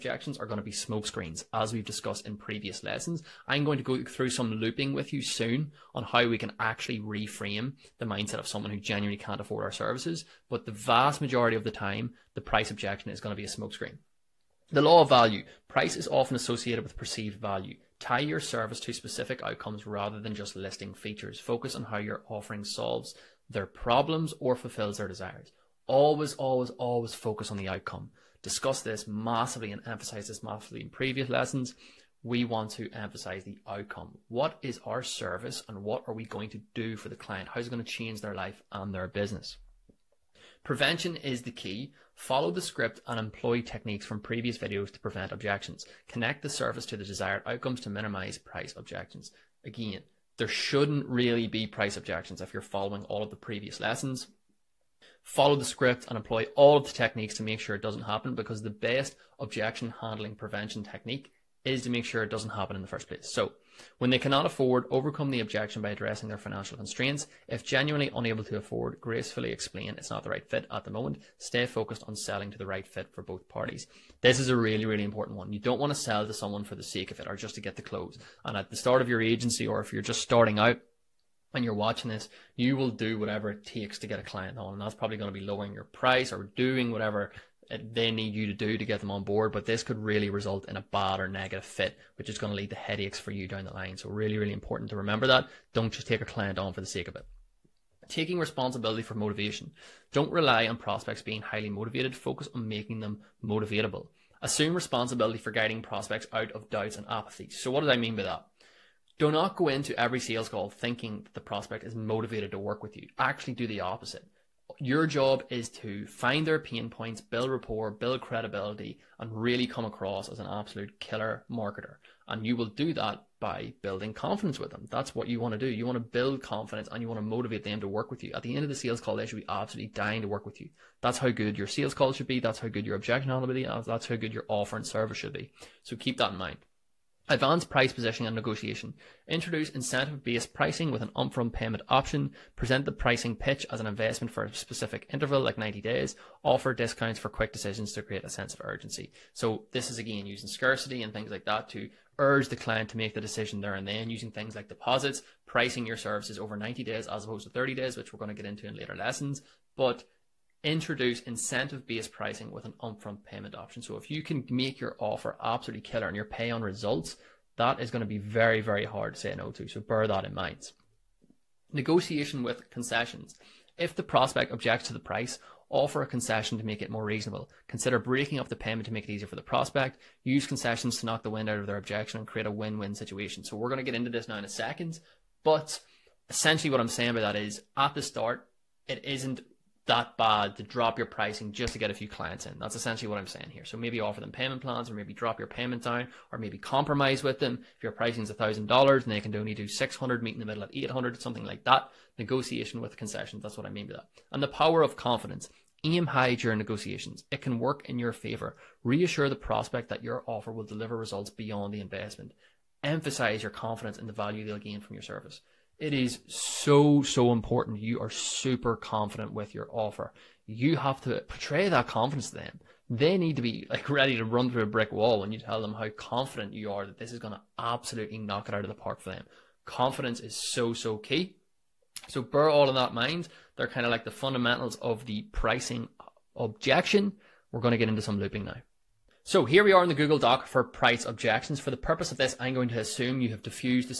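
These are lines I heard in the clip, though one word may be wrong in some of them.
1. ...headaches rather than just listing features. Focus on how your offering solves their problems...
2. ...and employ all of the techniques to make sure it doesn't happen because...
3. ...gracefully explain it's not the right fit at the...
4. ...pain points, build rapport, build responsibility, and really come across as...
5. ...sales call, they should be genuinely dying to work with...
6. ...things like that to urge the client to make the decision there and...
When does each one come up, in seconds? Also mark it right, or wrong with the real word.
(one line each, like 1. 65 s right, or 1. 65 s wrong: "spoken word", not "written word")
1. 19 s wrong: "outcomes", not "headaches"
2. 56 s right
3. 69 s right
4. 116 s wrong: "credibility", not "responsibility"
5. 128 s wrong: "absolutely", not "genuinely"
6. 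151 s right.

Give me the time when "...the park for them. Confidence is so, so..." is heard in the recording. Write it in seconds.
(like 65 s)
228 s.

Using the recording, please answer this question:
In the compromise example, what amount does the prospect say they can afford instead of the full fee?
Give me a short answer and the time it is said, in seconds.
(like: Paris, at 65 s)
$600, at 199 s.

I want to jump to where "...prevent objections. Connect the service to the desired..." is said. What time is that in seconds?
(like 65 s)
44 s.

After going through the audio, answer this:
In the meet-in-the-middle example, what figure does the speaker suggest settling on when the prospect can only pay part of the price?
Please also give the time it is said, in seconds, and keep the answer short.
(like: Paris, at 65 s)
$800, at 200 s.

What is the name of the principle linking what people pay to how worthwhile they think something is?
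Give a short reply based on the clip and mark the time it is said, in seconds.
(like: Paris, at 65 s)
The law of value, at 14 s.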